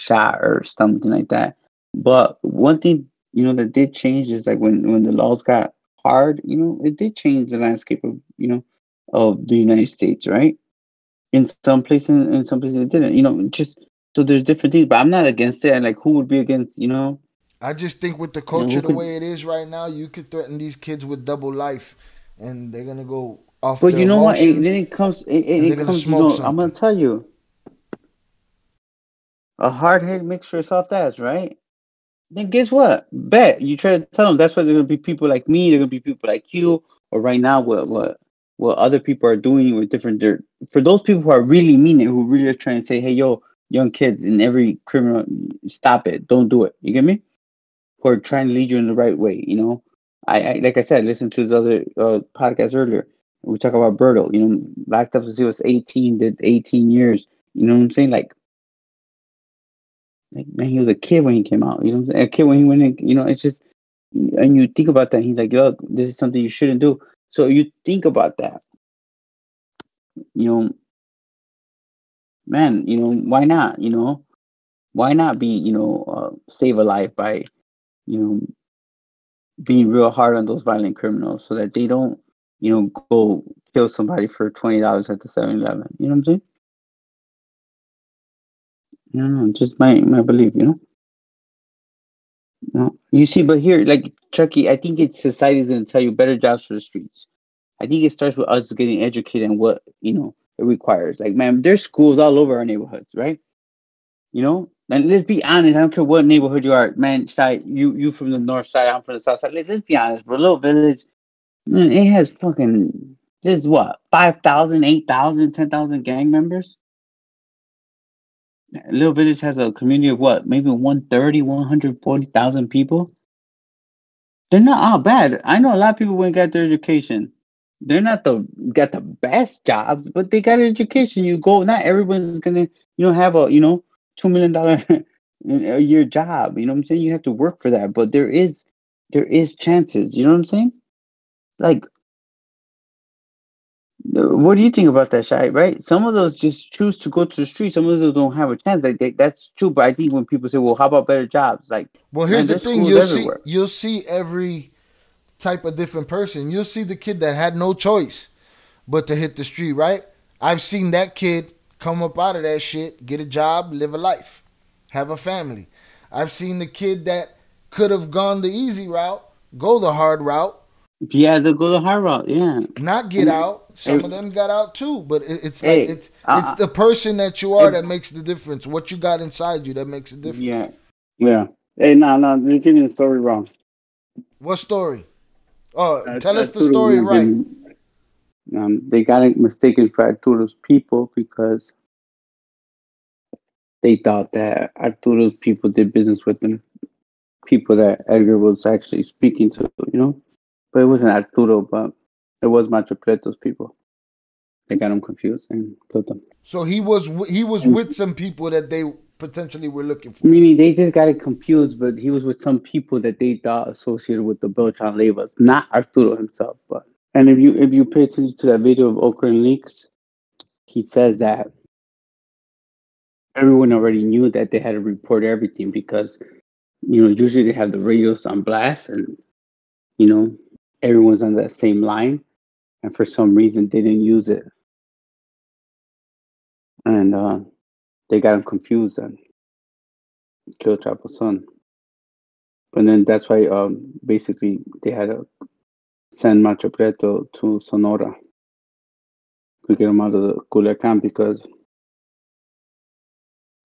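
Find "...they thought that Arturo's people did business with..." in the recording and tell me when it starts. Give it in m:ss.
3:13.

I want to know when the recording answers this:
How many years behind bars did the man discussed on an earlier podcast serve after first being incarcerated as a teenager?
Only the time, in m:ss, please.
0:56.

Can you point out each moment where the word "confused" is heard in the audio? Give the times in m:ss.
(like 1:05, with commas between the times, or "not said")
3:25, 3:31, 3:58.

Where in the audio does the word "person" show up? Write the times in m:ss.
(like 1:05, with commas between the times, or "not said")
2:36, 2:56.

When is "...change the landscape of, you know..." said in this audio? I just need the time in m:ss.
0:07.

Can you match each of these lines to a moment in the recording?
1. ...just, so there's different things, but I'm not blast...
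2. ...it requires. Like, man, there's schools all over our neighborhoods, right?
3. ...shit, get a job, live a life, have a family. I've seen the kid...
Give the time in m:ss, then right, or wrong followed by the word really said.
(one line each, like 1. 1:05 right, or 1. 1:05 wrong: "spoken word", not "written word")
1. 0:13 wrong: "against", not "blast"
2. 1:40 right
3. 2:42 right.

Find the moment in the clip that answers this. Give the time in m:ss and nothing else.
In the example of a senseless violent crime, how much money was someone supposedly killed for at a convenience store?
1:24.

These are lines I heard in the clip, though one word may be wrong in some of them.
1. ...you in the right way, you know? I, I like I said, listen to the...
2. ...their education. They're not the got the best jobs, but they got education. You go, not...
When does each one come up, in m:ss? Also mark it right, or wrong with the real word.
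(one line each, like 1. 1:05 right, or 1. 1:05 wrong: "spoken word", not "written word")
1. 0:48 right
2. 2:06 right.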